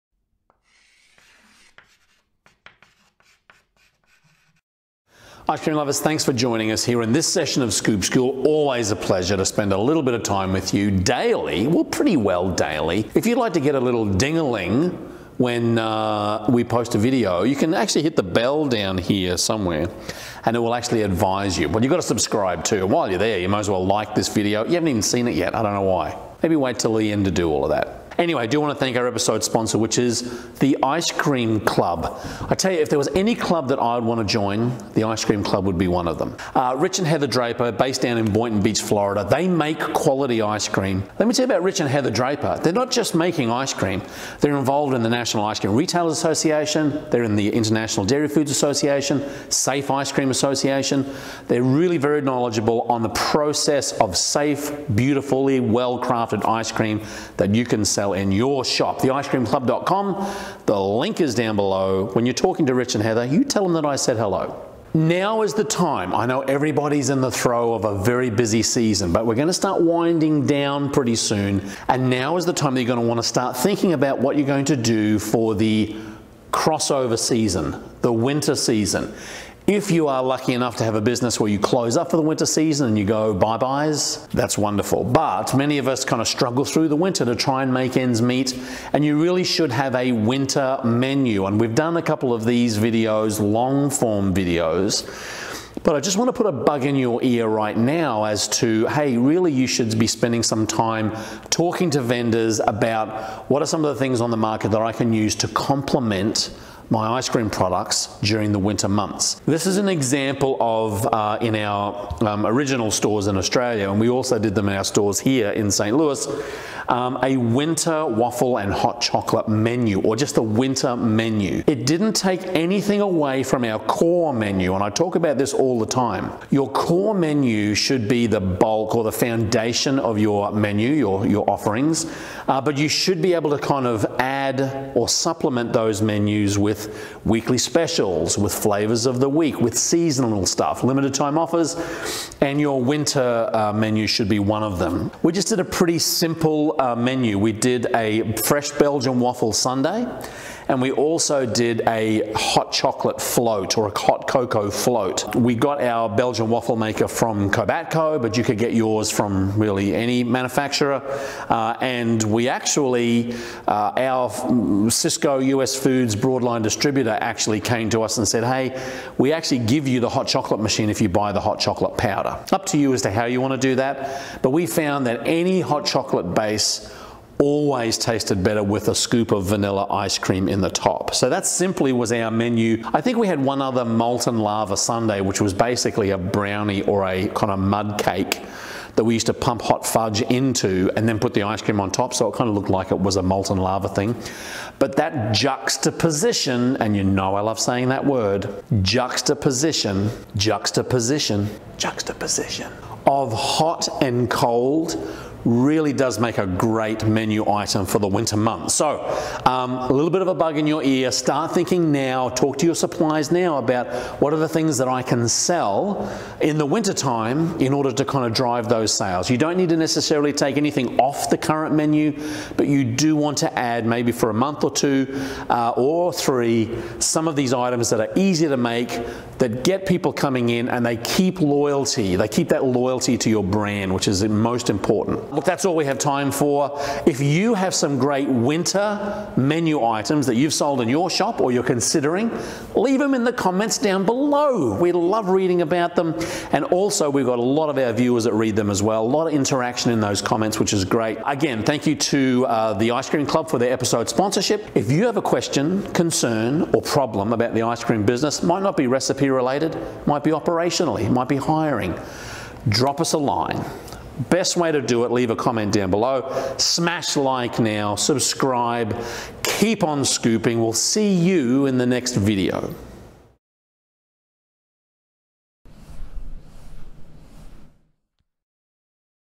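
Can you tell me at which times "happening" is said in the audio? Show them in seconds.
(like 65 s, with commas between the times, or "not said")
not said.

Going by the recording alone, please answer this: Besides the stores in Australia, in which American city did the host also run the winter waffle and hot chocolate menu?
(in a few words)
St. Louis.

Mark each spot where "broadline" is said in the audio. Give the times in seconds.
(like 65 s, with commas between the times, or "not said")
166 s.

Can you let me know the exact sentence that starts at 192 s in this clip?
So it kind of looked like it was a molten lava thing.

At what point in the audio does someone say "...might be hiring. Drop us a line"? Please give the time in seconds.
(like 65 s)
261 s.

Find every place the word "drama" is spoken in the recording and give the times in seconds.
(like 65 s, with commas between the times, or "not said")
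not said.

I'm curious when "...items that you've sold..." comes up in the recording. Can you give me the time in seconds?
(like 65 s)
239 s.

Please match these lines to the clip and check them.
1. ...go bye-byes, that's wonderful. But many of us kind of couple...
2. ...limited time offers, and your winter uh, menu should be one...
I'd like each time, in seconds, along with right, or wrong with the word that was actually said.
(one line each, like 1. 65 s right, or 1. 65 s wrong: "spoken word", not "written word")
1. 83 s wrong: "struggle", not "couple"
2. 140 s right.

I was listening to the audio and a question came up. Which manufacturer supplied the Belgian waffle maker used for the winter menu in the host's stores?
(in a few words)
Cobatco.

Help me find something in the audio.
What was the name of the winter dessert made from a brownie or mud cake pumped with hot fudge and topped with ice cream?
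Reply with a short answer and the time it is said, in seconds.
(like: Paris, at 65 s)
molten lava sundae, at 183 s.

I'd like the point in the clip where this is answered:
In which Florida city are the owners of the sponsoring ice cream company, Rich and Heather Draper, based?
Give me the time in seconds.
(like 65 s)
38 s.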